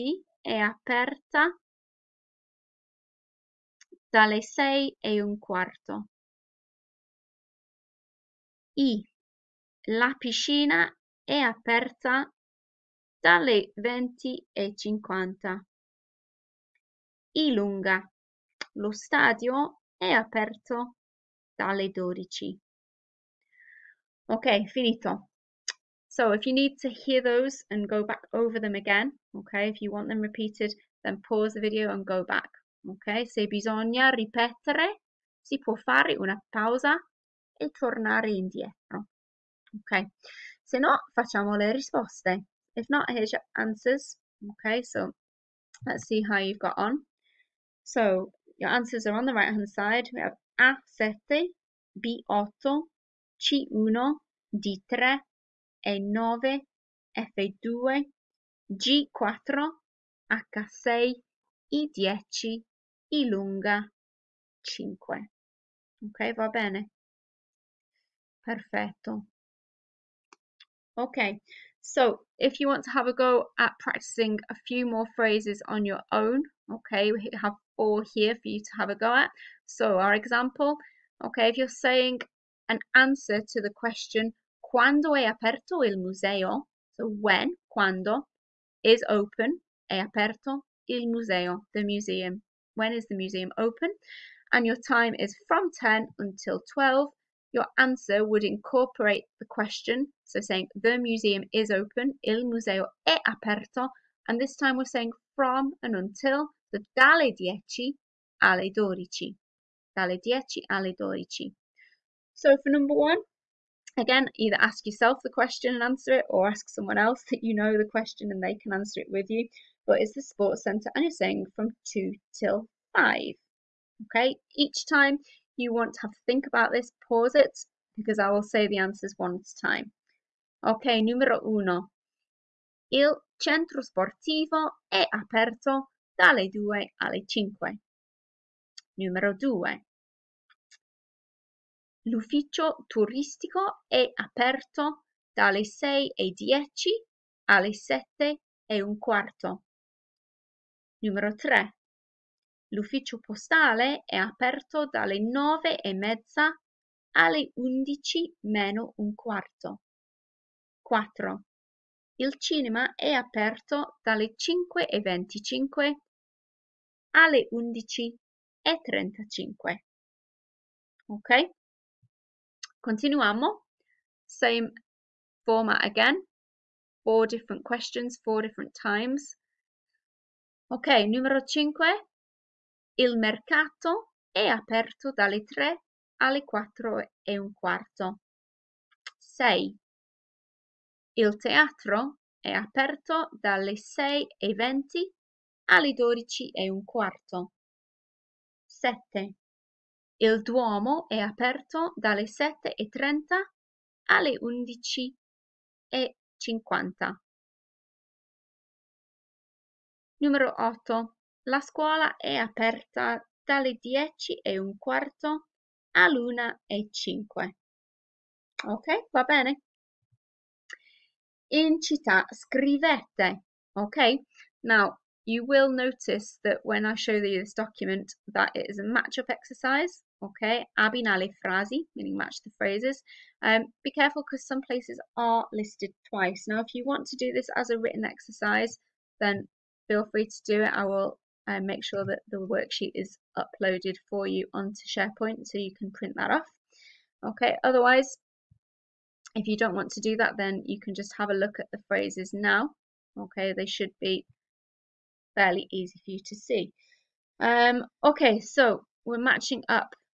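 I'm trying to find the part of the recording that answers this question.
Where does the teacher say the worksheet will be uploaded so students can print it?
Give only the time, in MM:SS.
04:04.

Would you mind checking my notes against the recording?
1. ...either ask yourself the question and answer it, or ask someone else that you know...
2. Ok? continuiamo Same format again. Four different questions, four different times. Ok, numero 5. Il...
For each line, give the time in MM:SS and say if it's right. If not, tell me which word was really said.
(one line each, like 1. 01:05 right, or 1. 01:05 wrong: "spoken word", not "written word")
1. 01:54 right
2. 02:51 right.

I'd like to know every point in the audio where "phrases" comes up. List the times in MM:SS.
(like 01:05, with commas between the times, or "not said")
01:15, 03:52, 04:11.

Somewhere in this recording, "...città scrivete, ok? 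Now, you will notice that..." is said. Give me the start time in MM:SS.
03:41.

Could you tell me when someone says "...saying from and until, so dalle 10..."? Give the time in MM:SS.
01:44.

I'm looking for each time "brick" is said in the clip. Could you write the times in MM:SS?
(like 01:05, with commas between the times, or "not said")
not said.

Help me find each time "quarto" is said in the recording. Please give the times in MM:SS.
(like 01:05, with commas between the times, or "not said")
00:05, 02:28, 02:39, 03:07, 03:16, 03:34.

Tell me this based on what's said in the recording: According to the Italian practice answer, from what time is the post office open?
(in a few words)
9:30.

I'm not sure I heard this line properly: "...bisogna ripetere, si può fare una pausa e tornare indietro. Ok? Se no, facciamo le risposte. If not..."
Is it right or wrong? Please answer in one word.
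right.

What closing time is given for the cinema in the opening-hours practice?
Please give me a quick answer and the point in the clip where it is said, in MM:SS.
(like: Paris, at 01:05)
11:35, at 02:47.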